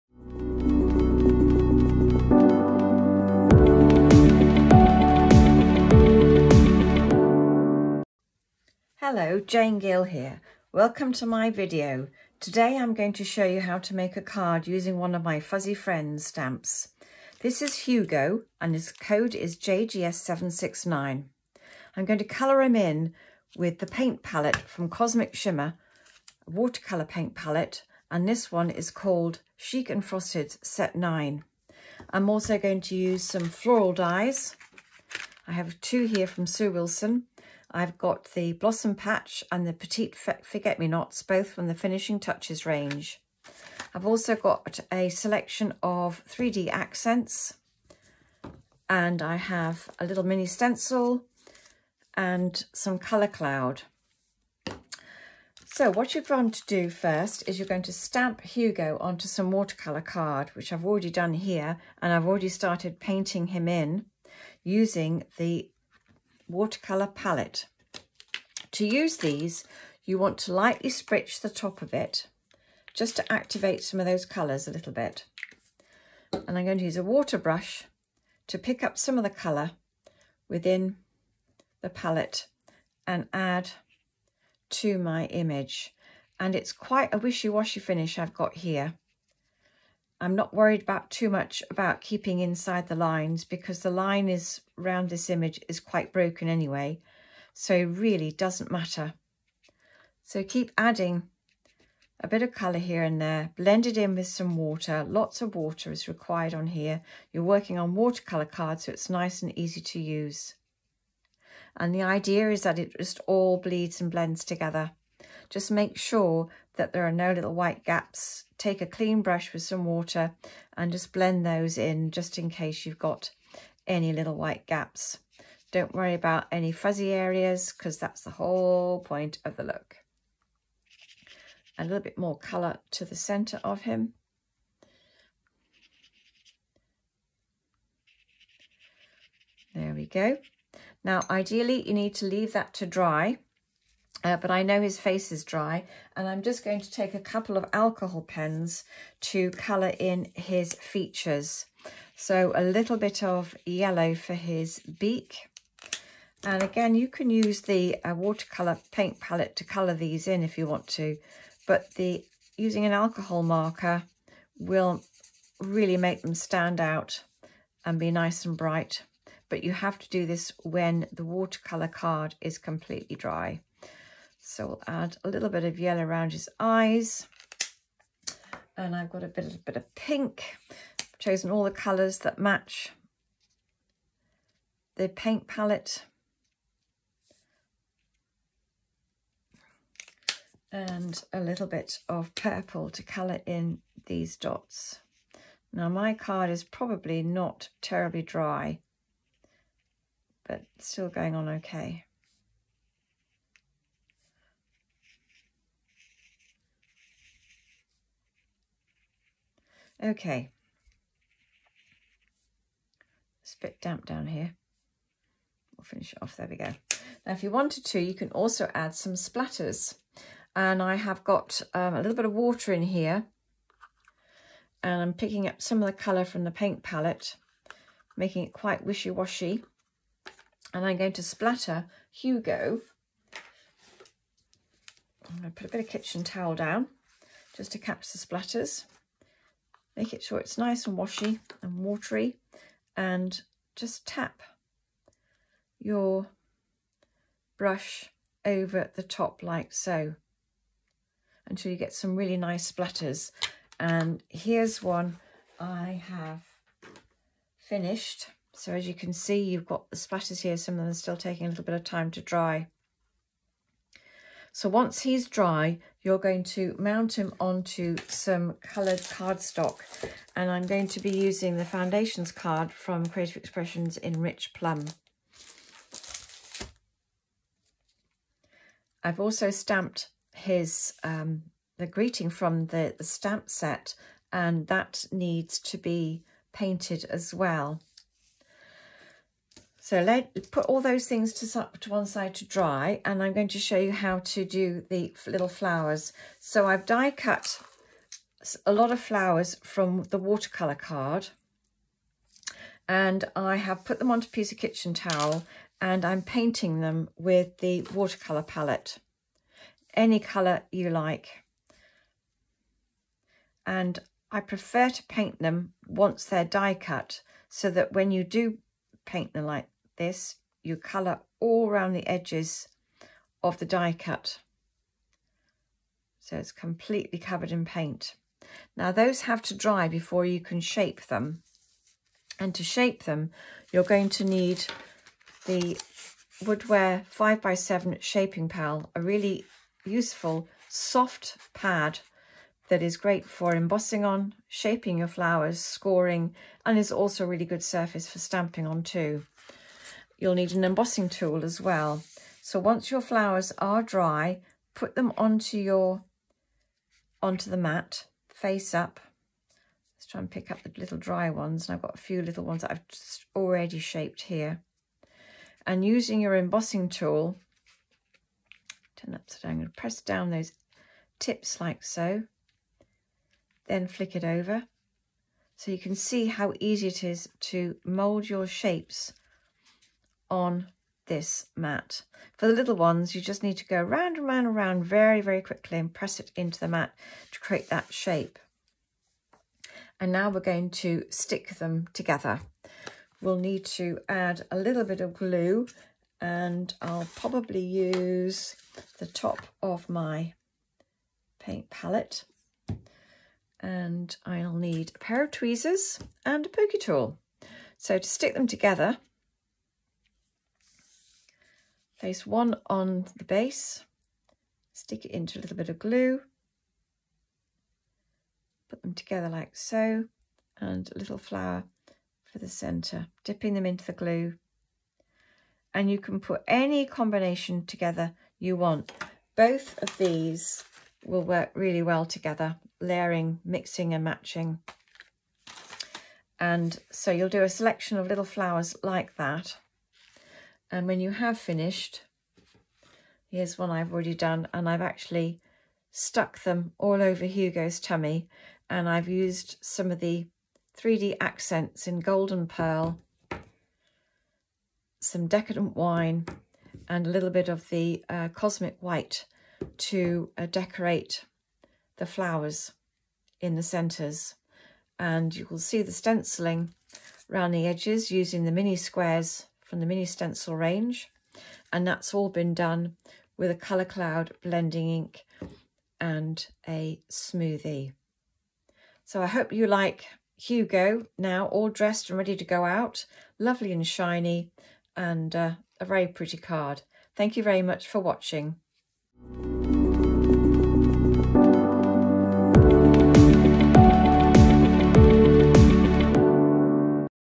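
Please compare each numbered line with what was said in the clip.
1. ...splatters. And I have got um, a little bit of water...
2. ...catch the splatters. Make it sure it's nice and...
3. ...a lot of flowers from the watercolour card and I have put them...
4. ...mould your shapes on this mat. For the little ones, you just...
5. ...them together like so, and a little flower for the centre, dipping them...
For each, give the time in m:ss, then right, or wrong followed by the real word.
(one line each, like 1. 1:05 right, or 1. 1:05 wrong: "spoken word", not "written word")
1. 3:39 right
2. 3:57 right
3. 4:58 right
4. 6:17 right
5. 6:58 right.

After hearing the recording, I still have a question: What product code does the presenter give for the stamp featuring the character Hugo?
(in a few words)
JGS769.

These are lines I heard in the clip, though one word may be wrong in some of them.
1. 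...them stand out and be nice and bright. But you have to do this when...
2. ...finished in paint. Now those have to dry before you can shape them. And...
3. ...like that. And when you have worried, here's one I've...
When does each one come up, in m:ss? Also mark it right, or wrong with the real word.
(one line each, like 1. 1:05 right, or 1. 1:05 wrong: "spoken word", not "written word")
1. 2:46 right
2. 5:27 wrong: "covered", not "finished"
3. 7:18 wrong: "finished", not "worried".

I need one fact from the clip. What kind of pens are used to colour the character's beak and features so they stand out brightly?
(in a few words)
alcohol pens.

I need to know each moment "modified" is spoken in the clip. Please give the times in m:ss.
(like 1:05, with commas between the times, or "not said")
not said.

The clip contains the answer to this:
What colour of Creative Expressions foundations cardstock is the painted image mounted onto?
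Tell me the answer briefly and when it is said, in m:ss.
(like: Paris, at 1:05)
Rich Plum, at 4:34.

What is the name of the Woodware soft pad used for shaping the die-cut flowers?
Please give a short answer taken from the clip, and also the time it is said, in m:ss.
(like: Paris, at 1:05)
Shaping Pal, at 5:38.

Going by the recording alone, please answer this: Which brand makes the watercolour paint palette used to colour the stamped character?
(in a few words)
Cosmic Shimmer.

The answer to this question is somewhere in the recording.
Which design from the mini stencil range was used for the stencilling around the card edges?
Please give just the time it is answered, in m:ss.
7:48.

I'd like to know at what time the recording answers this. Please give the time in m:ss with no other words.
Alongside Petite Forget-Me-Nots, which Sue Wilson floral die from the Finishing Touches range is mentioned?
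0:38.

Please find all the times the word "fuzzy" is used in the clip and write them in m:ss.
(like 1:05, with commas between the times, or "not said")
0:15, 2:06.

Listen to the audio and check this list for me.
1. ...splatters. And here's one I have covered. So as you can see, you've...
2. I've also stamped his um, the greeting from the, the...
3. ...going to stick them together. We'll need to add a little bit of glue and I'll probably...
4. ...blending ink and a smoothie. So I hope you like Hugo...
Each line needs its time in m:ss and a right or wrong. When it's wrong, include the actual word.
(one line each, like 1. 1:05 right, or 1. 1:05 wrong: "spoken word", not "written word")
1. 4:12 wrong: "finished", not "covered"
2. 4:39 right
3. 6:30 right
4. 7:54 right.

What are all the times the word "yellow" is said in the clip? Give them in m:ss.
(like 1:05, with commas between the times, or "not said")
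2:33, 2:55.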